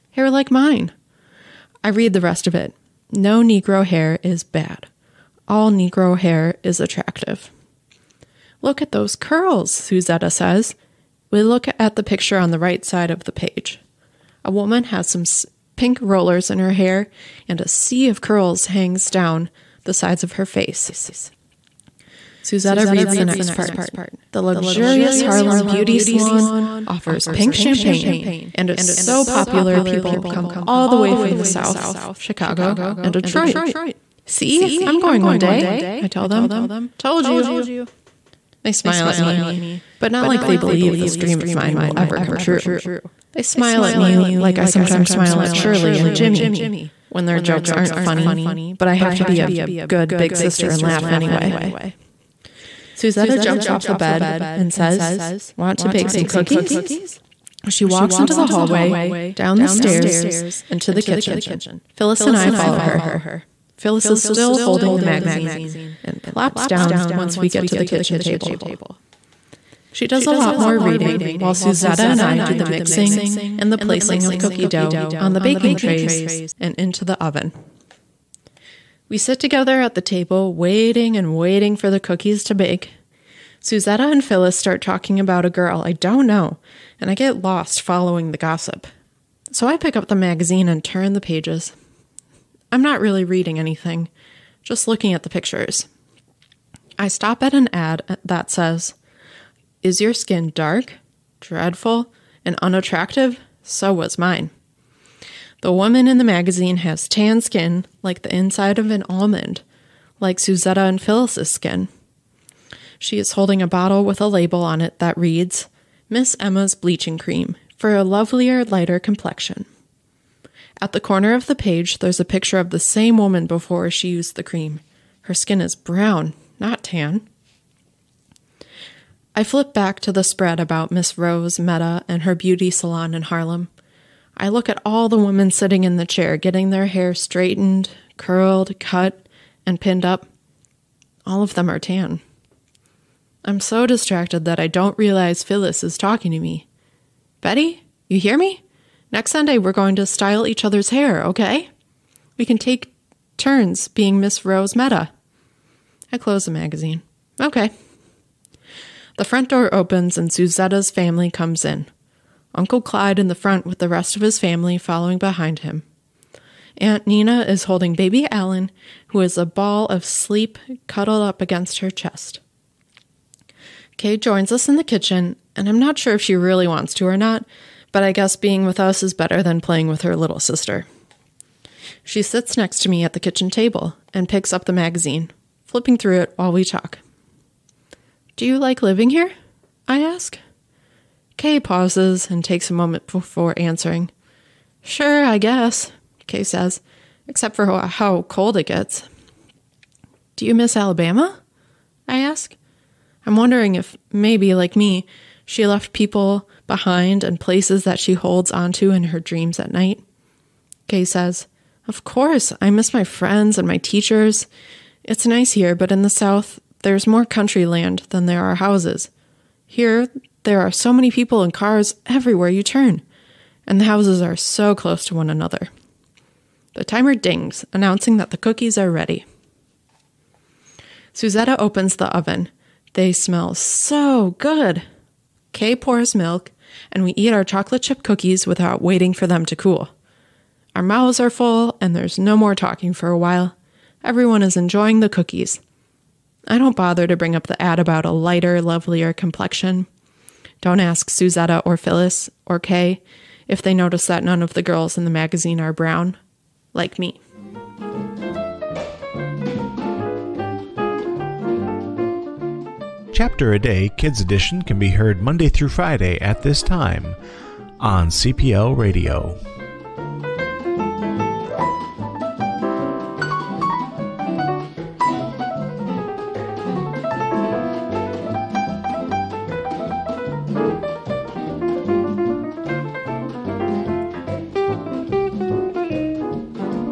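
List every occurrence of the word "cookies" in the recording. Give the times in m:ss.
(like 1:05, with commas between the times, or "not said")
0:56, 1:14, 1:21, 3:48, 3:58, 4:05.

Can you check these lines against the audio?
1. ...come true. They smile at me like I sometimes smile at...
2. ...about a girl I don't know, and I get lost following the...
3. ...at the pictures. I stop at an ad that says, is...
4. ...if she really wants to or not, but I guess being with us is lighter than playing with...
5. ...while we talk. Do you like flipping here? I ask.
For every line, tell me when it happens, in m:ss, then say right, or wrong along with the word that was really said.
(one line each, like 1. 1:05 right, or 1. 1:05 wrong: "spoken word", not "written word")
1. 0:42 right
2. 1:25 right
3. 1:35 right
4. 2:56 wrong: "better", not "lighter"
5. 3:06 wrong: "living", not "flipping".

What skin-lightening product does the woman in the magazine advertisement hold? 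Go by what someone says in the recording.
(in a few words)
Miss Emma's Bleaching Cream.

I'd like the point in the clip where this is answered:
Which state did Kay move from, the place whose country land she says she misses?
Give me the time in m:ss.
3:20.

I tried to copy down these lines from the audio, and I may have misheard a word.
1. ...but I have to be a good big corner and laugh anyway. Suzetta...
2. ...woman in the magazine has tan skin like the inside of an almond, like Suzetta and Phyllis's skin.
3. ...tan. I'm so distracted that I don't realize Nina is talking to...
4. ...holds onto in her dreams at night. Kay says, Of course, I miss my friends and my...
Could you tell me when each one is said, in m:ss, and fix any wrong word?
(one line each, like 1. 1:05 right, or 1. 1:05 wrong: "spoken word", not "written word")
1. 0:48 wrong: "sister", not "corner"
2. 1:45 right
3. 2:21 wrong: "Phyllis", not "Nina"
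4. 3:28 right.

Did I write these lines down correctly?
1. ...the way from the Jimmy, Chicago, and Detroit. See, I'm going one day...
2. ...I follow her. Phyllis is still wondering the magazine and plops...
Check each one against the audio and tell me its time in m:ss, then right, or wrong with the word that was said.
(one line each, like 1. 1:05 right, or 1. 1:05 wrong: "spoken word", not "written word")
1. 0:30 wrong: "South", not "Jimmy"
2. 1:02 wrong: "holding", not "wondering".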